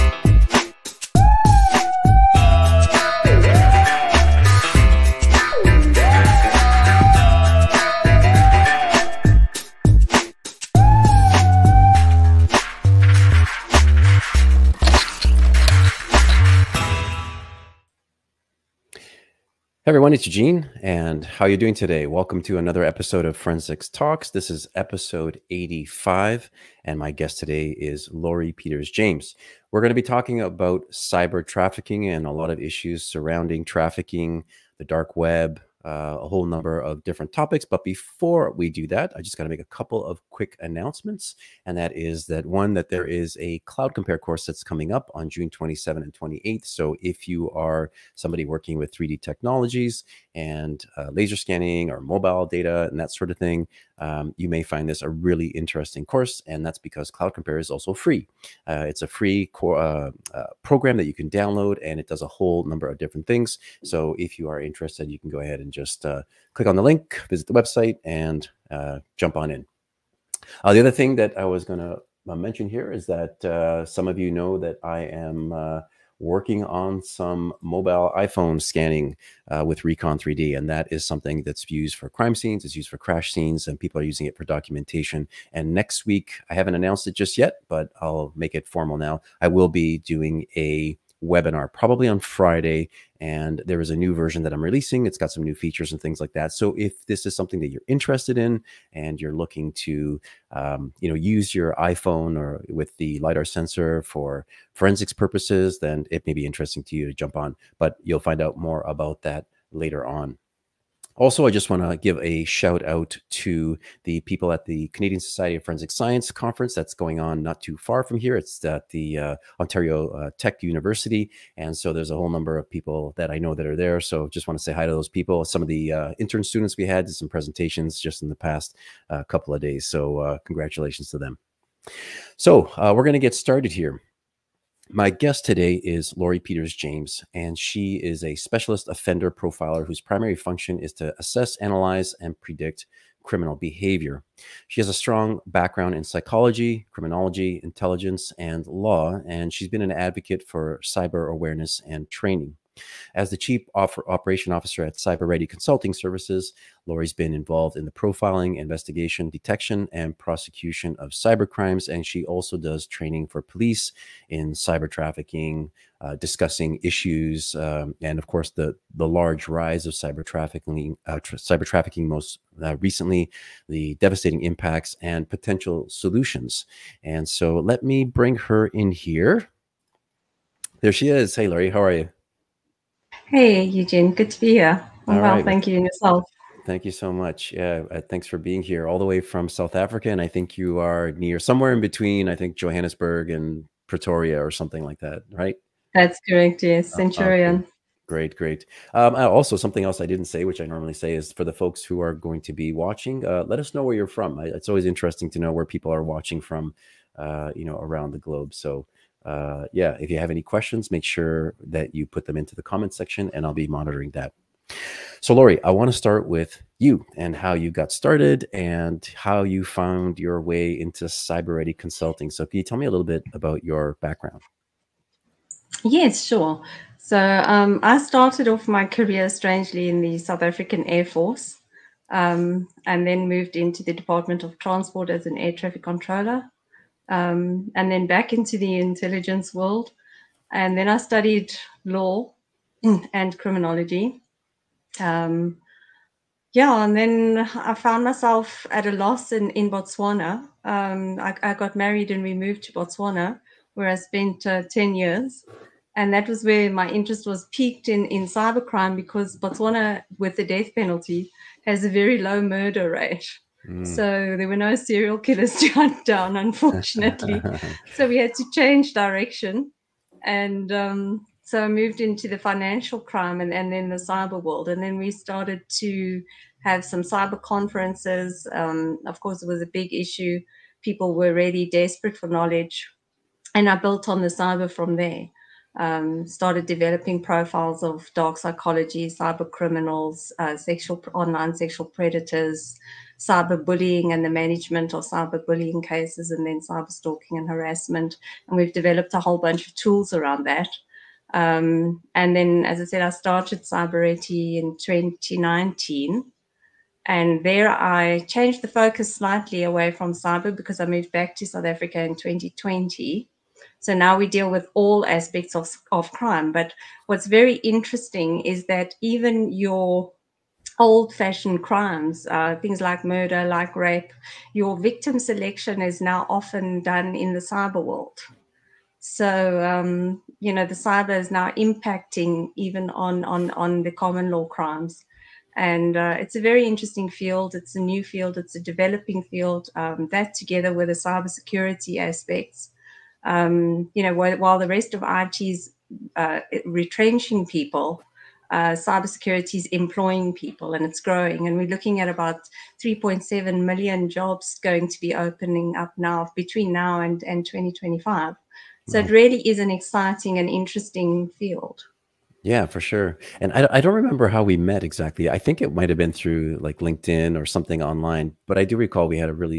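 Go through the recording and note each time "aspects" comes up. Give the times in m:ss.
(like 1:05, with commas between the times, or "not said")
5:15, 5:41.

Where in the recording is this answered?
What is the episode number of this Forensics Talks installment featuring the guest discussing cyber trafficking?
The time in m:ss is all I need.
0:24.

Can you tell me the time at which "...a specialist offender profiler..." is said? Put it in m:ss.
2:18.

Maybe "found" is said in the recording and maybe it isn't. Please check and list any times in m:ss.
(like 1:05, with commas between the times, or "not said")
3:39, 4:07.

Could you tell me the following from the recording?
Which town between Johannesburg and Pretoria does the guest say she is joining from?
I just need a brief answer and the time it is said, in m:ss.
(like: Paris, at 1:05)
Centurion, at 3:16.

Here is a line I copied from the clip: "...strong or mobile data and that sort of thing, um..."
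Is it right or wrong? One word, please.
wrong.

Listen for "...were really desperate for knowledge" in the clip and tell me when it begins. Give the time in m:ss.
4:41.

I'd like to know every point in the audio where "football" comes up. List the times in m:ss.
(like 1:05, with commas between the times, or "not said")
not said.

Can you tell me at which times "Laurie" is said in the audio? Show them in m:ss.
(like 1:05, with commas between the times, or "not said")
0:28, 2:16, 2:36, 3:35.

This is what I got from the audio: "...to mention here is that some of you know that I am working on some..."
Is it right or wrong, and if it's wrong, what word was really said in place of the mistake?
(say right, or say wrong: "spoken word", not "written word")
right.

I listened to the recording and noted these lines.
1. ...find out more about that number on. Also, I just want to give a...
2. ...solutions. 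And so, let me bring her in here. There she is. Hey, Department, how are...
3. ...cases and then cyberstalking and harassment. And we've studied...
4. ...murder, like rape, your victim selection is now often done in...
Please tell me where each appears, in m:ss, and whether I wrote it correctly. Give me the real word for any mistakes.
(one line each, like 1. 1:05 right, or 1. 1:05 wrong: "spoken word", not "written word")
1. 1:48 wrong: "later", not "number"
2. 2:55 wrong: "Lori", not "Department"
3. 4:55 wrong: "developed", not "studied"
4. 5:23 right.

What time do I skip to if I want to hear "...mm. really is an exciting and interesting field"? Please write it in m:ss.
5:59.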